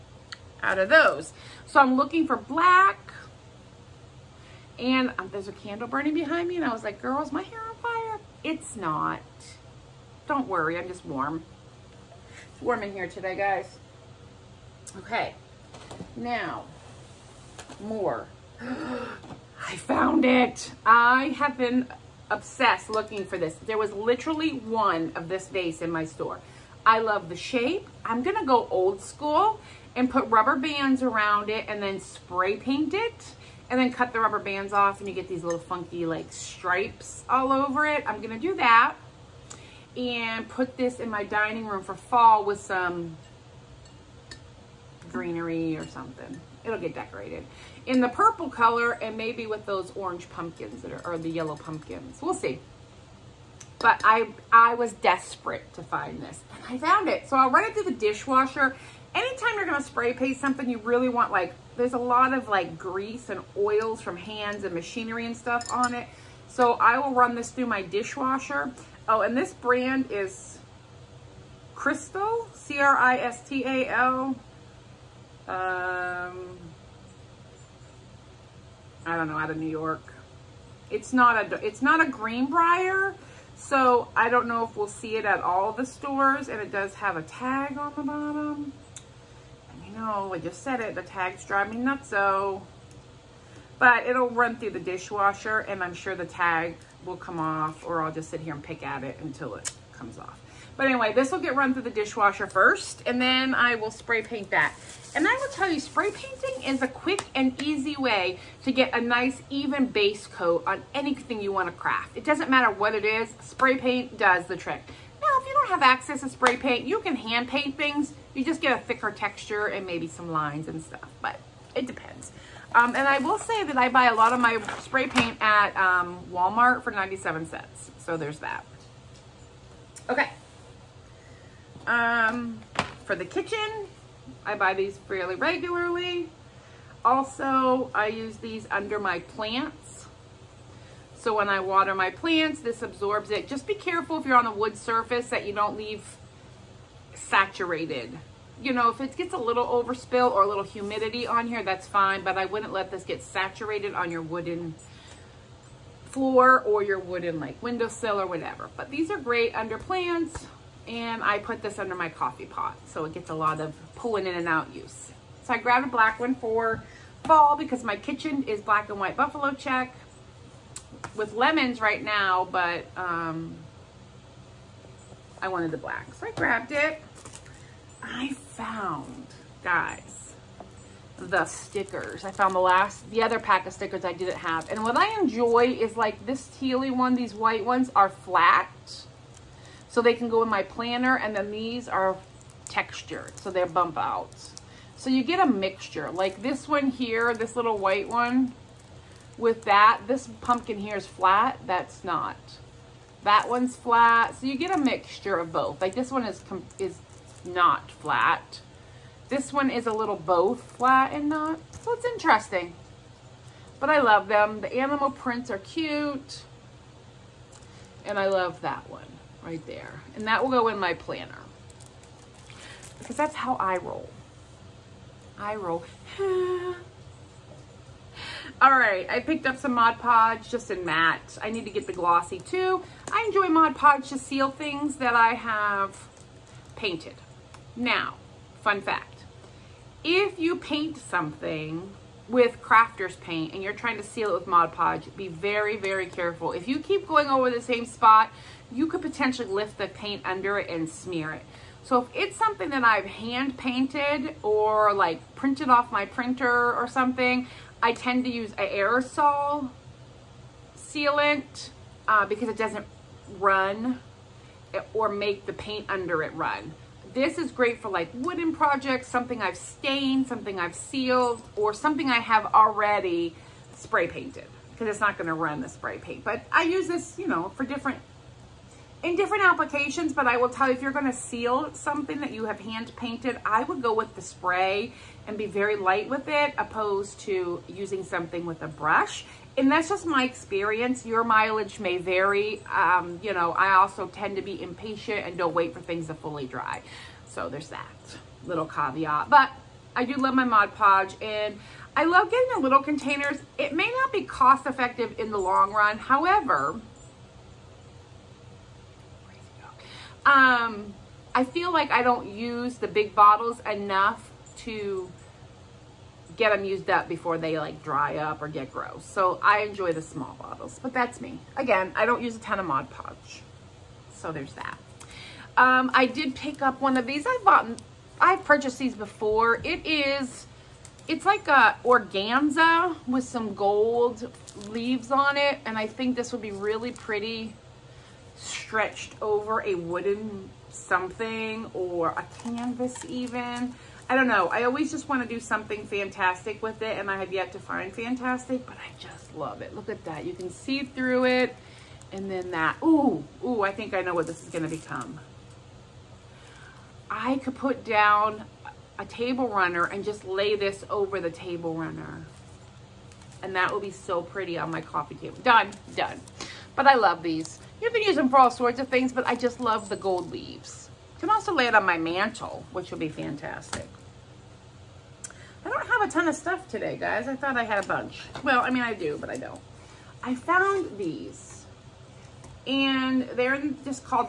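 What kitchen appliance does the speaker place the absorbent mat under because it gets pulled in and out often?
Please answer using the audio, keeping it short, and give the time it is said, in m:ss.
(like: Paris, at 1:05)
coffee pot, at 2:42.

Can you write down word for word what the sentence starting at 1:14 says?
Um, I don't know, out of New York.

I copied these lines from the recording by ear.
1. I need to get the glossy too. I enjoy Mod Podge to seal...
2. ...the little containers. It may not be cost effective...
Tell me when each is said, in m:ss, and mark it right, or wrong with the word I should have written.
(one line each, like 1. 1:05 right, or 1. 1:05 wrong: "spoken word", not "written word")
1. 3:51 right
2. 5:02 right.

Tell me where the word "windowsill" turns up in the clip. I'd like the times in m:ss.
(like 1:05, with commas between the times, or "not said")
2:37.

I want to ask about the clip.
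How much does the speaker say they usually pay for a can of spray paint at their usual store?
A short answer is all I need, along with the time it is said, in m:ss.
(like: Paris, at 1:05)
97 cents, at 2:06.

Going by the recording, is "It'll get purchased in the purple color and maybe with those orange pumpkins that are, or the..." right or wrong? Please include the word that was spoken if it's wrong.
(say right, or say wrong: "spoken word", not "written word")
wrong: "decorated", not "purchased".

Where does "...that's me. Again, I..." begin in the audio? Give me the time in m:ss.
5:20.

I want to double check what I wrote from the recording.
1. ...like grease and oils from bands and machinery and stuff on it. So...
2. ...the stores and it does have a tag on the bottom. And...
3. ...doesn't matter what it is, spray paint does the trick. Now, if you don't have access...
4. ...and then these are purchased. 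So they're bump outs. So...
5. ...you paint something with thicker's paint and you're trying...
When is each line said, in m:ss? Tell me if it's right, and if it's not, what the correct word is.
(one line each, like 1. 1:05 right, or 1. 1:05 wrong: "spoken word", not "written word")
1. 1:02 wrong: "hands", not "bands"
2. 1:25 right
3. 1:52 right
4. 3:11 wrong: "textured", not "purchased"
5. 4:00 wrong: "crafter", not "thicker".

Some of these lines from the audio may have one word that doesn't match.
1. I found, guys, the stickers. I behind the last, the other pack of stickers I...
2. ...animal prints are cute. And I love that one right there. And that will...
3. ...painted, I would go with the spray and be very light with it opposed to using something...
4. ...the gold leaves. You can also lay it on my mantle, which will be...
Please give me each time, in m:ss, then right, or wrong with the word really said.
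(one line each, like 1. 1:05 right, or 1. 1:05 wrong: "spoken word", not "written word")
1. 2:58 wrong: "found", not "behind"
2. 3:34 right
3. 4:42 right
4. 6:09 right.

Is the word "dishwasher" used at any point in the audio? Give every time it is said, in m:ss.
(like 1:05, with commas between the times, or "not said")
0:57, 1:07, 1:34, 1:41.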